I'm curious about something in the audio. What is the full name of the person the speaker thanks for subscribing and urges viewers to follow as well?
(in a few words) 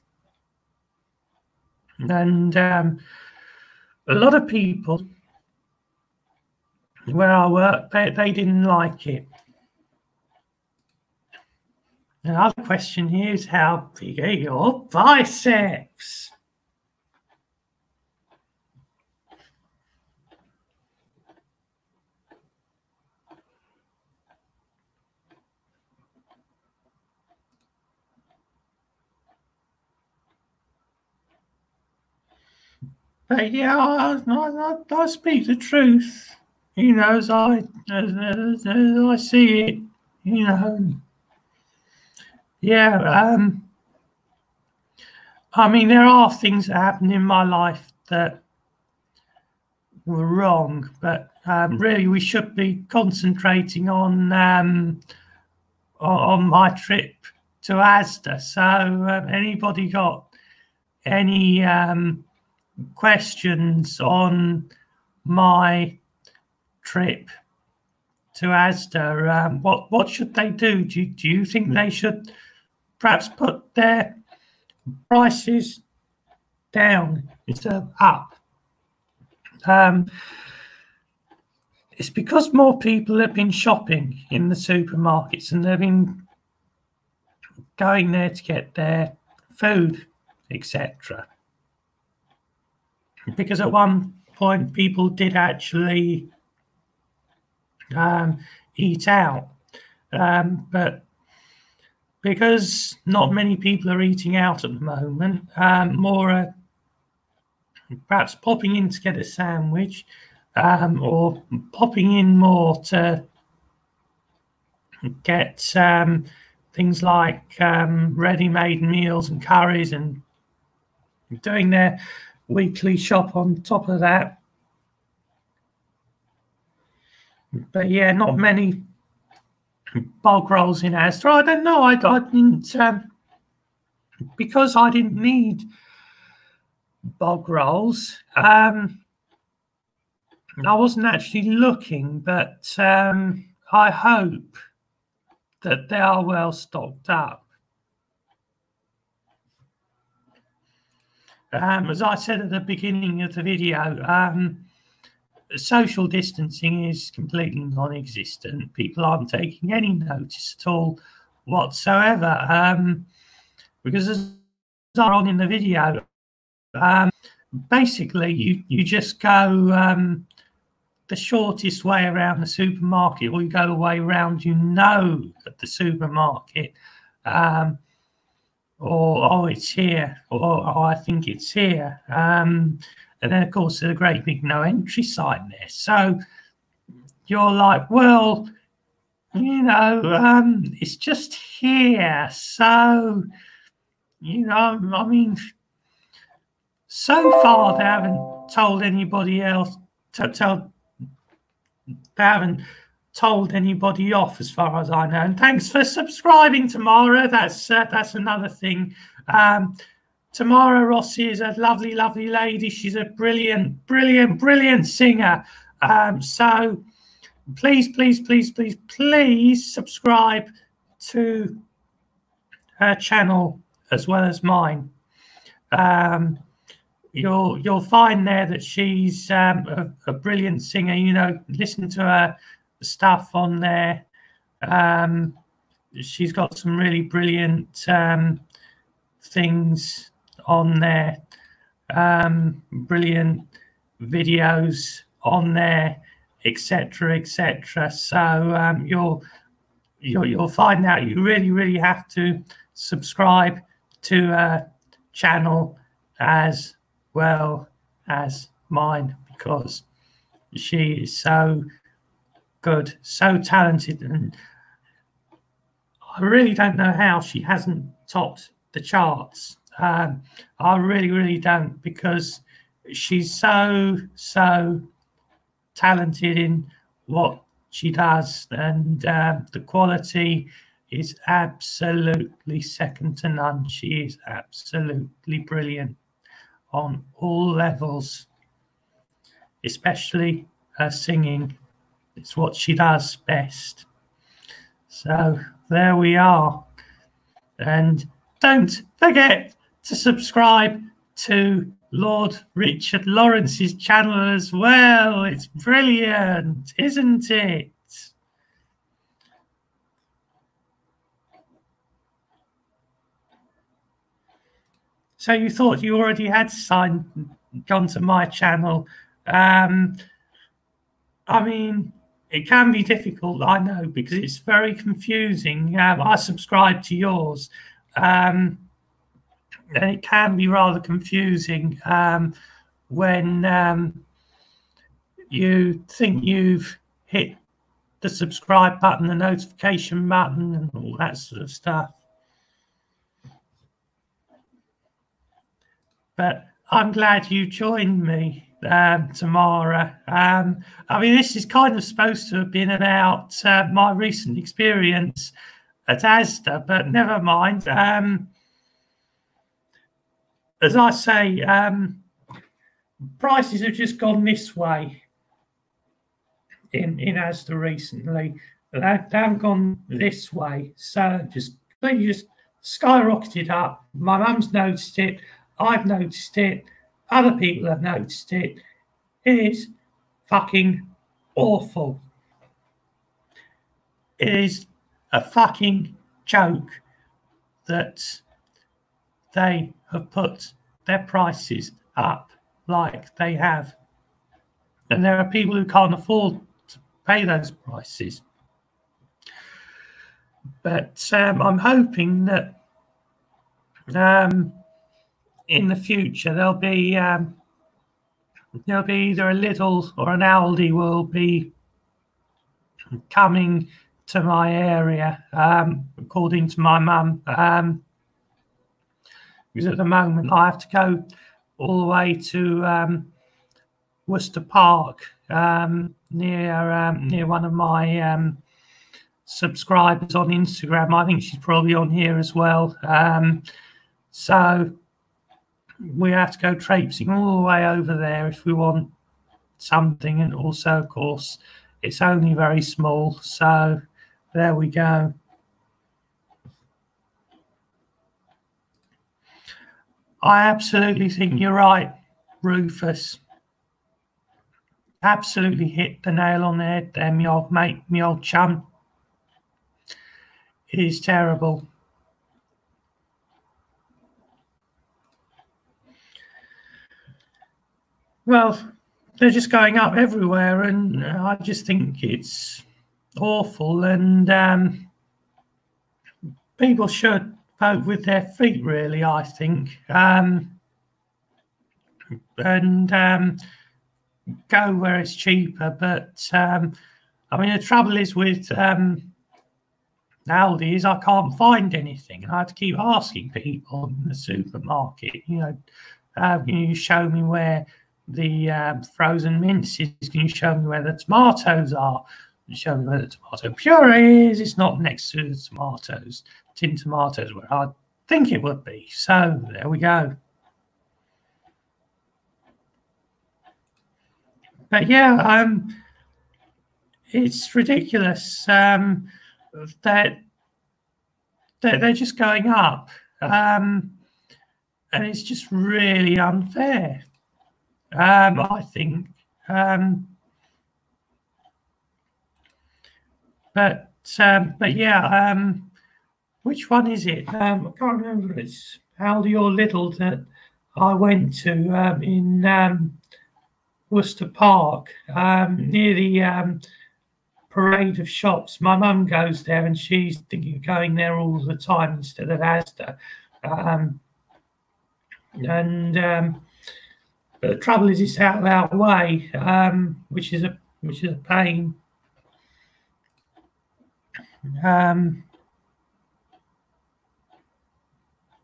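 Tamara Rossi.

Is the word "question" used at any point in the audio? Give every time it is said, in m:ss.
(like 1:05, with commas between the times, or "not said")
0:12, 1:02.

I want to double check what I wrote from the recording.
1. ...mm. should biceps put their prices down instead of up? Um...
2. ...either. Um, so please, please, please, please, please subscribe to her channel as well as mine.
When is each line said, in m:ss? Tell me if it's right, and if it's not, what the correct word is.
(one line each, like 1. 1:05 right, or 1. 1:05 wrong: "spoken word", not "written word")
1. 1:11 wrong: "perhaps", not "biceps"
2. 3:34 wrong: "singer", not "either".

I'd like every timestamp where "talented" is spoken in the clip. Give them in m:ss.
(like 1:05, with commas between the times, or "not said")
4:23, 4:35.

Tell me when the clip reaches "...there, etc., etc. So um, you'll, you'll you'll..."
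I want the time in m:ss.
4:05.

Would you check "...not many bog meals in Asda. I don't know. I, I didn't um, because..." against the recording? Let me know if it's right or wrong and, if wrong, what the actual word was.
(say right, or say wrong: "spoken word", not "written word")
wrong: "rolls", not "meals".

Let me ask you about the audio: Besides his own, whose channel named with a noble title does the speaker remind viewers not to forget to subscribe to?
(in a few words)
Lord Richard Lawrence.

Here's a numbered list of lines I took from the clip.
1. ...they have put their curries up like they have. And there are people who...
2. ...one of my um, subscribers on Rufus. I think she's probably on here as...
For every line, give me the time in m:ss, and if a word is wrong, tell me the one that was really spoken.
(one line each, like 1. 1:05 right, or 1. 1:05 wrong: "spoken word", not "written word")
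1. 6:29 wrong: "prices", not "curries"
2. 7:07 wrong: "Instagram", not "Rufus".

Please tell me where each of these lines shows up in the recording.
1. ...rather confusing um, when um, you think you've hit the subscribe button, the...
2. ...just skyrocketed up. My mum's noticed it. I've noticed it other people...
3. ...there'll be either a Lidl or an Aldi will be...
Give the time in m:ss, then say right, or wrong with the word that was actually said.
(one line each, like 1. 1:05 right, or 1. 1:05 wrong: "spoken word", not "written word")
1. 5:30 right
2. 6:12 right
3. 6:48 right.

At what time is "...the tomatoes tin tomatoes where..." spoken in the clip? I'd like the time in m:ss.
8:25.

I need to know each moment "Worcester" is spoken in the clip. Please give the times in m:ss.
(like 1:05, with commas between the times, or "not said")
7:04, 9:03.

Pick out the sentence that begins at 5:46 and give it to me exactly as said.
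But I'm glad you joined me um, tomorrow.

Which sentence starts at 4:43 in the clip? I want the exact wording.
She is absolutely brilliant on all levels, especially her singing.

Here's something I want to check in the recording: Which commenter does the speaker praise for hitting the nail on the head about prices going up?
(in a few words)
Rufus.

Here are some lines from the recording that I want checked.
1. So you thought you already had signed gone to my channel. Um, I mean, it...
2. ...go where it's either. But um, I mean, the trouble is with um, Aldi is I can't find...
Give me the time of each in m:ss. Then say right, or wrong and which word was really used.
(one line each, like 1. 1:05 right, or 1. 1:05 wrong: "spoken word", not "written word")
1. 5:15 right
2. 8:04 wrong: "cheaper", not "either".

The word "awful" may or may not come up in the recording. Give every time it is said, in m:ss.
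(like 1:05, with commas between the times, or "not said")
6:21, 7:53.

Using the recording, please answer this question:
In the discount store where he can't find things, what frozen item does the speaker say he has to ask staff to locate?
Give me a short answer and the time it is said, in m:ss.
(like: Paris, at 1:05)
Frozen mince, at 8:18.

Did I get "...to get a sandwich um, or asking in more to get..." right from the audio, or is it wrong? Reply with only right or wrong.
wrong.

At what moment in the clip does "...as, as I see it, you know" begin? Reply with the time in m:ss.
0:38.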